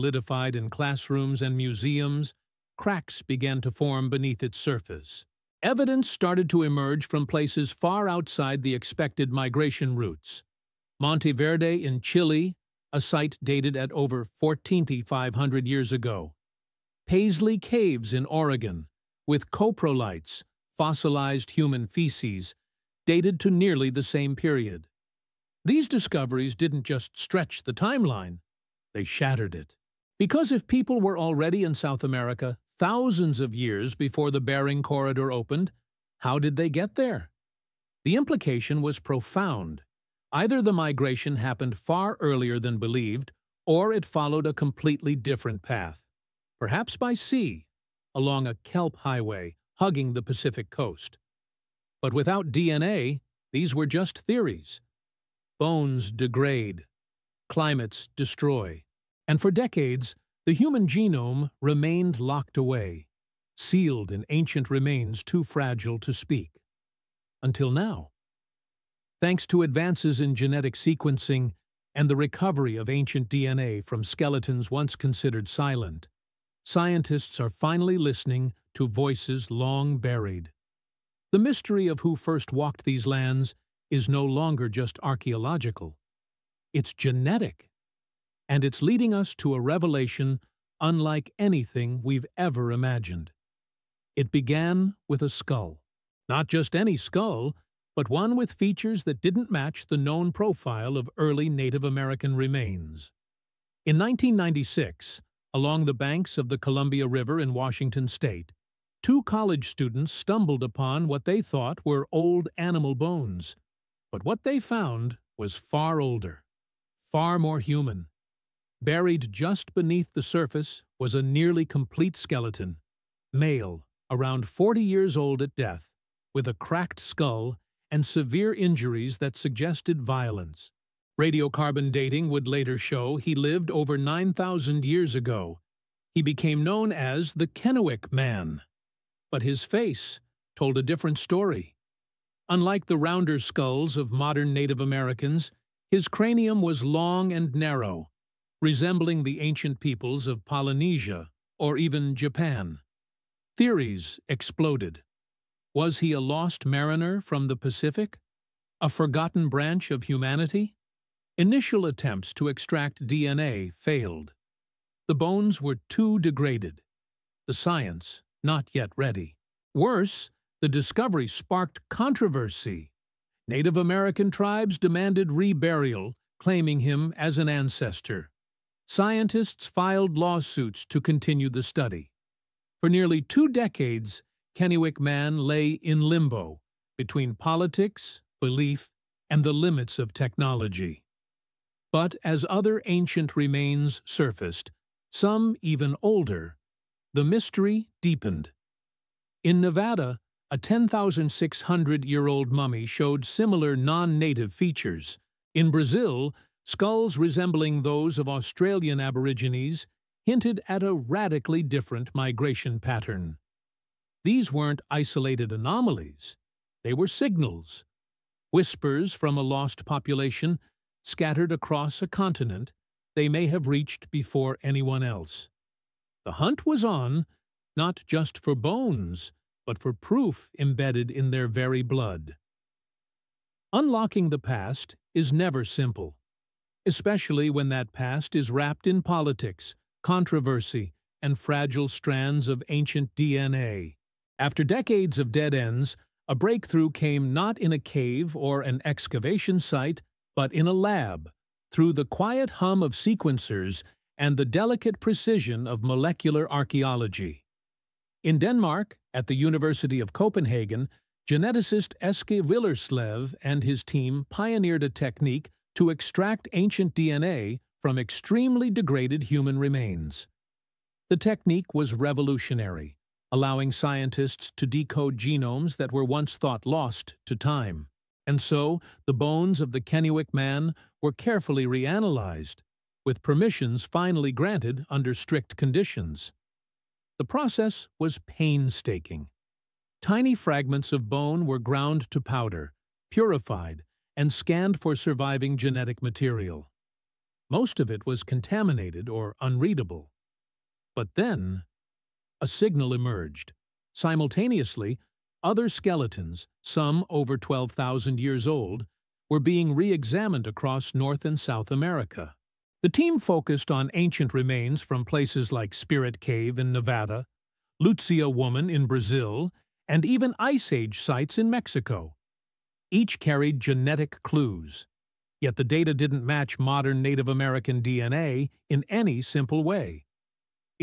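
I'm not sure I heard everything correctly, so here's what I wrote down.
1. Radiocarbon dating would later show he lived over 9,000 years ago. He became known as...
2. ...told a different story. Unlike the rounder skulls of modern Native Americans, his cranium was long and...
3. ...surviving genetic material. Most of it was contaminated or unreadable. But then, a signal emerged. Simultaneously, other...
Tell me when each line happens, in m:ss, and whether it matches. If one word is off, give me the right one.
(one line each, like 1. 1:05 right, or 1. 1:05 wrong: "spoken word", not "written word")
1. 2:11 right
2. 2:20 right
3. 4:54 right.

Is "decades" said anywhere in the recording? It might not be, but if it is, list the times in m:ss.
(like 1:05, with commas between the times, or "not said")
0:59, 3:03, 4:04.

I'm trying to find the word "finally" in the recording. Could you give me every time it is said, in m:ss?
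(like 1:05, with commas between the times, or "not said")
1:17, 4:43.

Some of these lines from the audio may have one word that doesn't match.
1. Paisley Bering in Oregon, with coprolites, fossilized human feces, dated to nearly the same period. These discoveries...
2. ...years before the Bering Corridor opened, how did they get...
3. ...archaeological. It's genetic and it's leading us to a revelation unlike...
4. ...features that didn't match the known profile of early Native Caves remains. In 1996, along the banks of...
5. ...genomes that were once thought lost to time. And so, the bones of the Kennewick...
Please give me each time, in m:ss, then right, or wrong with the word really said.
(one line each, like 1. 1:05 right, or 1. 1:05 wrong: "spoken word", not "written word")
1. 0:17 wrong: "Caves", not "Bering"
2. 0:33 right
3. 1:25 right
4. 1:38 wrong: "American", not "Caves"
5. 4:35 right.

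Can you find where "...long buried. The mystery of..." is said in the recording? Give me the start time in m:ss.
1:19.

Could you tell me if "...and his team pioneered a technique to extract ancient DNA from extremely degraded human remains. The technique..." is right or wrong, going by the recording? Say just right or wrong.
right.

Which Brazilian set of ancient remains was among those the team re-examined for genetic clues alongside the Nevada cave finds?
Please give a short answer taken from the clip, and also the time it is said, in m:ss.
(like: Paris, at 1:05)
Luzia Woman, at 5:17.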